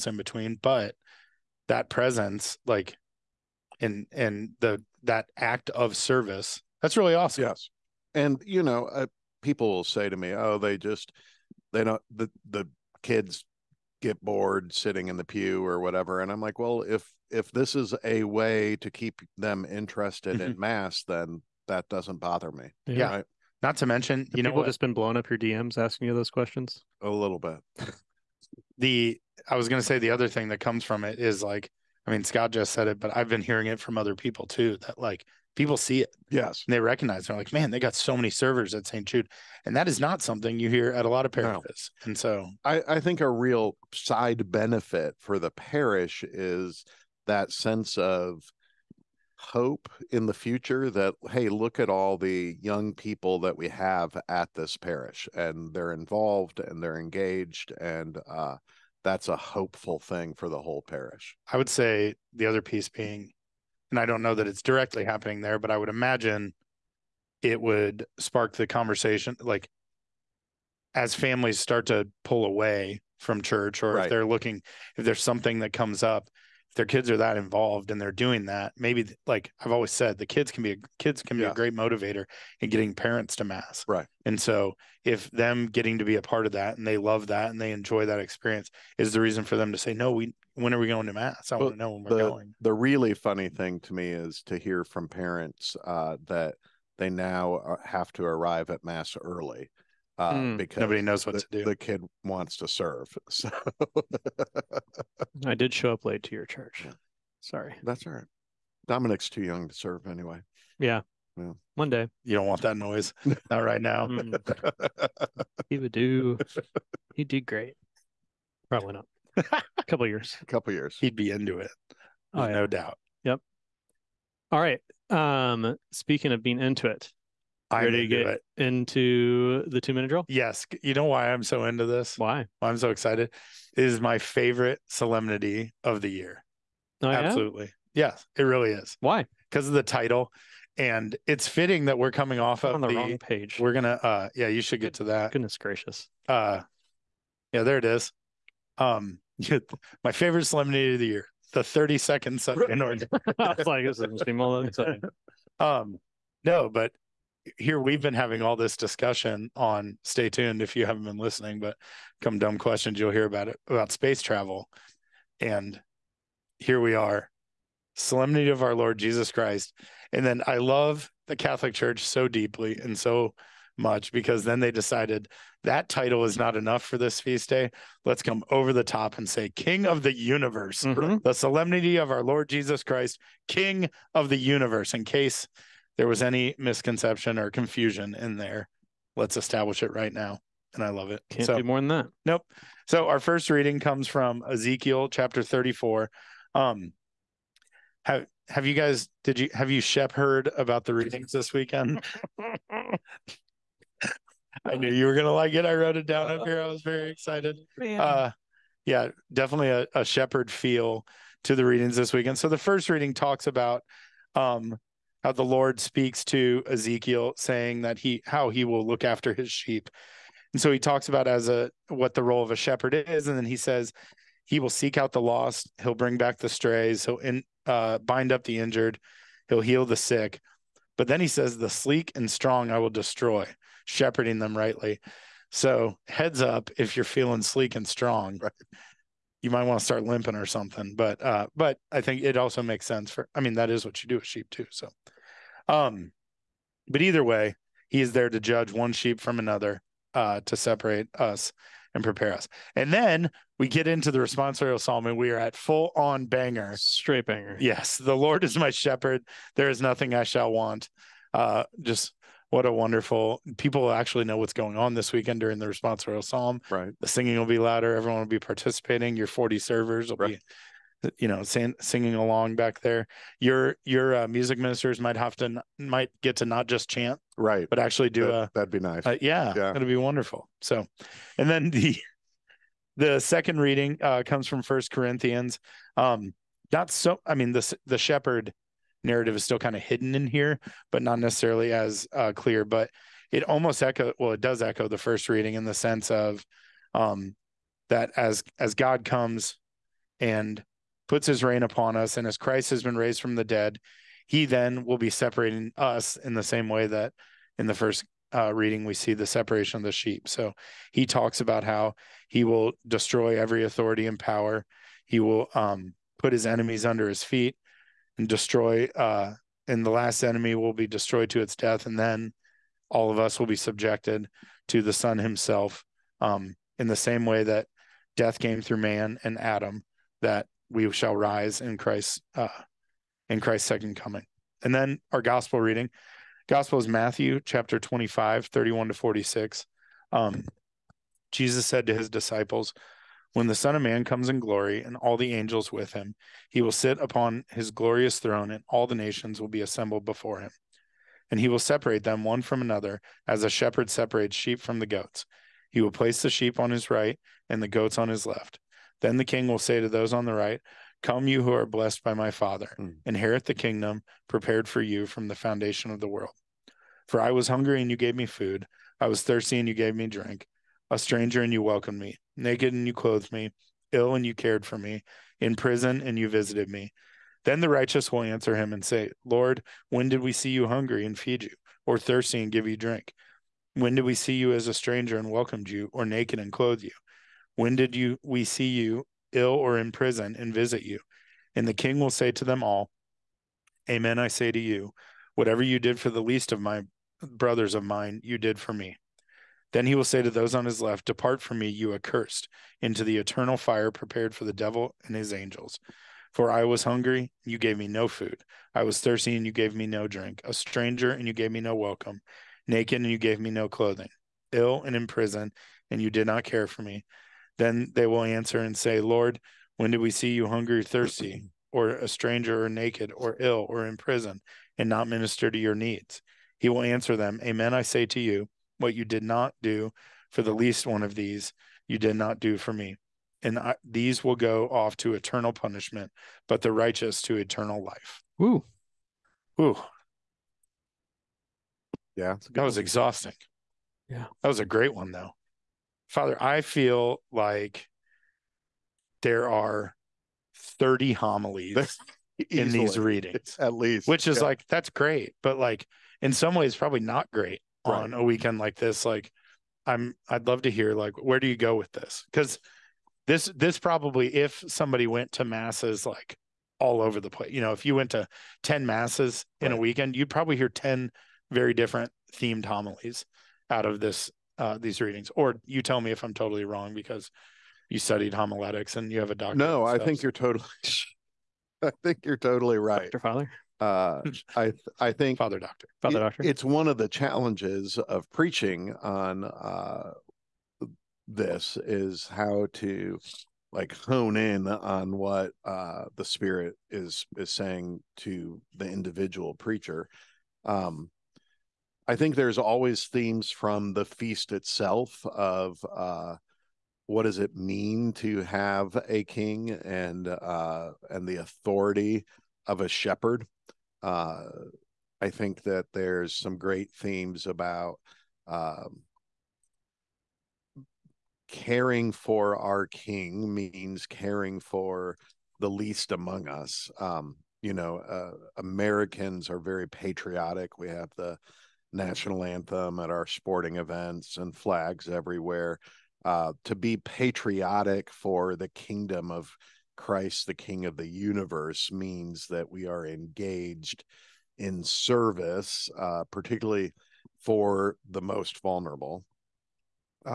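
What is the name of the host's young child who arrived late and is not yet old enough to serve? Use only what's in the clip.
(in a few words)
Dominic.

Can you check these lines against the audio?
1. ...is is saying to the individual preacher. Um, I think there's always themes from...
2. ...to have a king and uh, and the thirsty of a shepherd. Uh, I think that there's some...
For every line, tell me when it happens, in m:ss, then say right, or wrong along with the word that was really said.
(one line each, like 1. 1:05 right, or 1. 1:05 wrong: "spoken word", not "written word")
1. 8:16 right
2. 8:28 wrong: "authority", not "thirsty".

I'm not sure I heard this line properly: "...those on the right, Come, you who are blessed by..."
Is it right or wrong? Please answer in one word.
right.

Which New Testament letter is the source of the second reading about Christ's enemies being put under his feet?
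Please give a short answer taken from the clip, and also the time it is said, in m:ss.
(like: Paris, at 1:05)
First Corinthians, at 4:44.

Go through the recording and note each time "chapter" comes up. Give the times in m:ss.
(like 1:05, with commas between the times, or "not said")
3:15, 5:37.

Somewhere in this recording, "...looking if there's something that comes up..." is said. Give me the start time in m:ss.
1:14.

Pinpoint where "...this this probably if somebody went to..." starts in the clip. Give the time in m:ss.
7:43.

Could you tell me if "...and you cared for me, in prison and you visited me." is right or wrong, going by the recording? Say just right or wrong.
right.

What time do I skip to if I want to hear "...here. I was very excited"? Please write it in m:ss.
3:26.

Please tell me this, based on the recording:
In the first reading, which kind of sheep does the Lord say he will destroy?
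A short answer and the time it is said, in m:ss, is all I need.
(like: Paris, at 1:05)
The sleek and strong, at 3:51.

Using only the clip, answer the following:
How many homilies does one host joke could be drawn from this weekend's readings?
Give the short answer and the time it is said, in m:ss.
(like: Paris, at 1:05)
30, at 7:30.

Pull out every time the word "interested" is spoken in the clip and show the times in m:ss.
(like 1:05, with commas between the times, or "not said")
0:19.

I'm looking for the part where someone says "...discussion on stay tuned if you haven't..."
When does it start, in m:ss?
2:38.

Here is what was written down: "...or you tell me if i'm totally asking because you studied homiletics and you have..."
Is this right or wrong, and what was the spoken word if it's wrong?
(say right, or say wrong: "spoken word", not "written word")
wrong: "wrong", not "asking".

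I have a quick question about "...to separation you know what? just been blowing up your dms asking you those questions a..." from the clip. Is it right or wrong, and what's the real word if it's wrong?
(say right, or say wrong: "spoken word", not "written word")
wrong: "mention", not "separation".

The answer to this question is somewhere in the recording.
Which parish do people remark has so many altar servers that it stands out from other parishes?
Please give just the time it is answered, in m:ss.
0:38.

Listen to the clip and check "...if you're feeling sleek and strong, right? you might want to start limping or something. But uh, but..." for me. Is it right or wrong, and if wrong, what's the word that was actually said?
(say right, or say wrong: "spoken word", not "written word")
right.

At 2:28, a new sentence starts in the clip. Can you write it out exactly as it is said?
Um my favorite lemonade of the year, the 30 second in order.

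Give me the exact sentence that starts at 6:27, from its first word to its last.
When did you we see you ill or in prison and visit you?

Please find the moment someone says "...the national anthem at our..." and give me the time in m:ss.
8:51.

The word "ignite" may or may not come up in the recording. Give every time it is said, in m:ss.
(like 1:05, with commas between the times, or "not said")
not said.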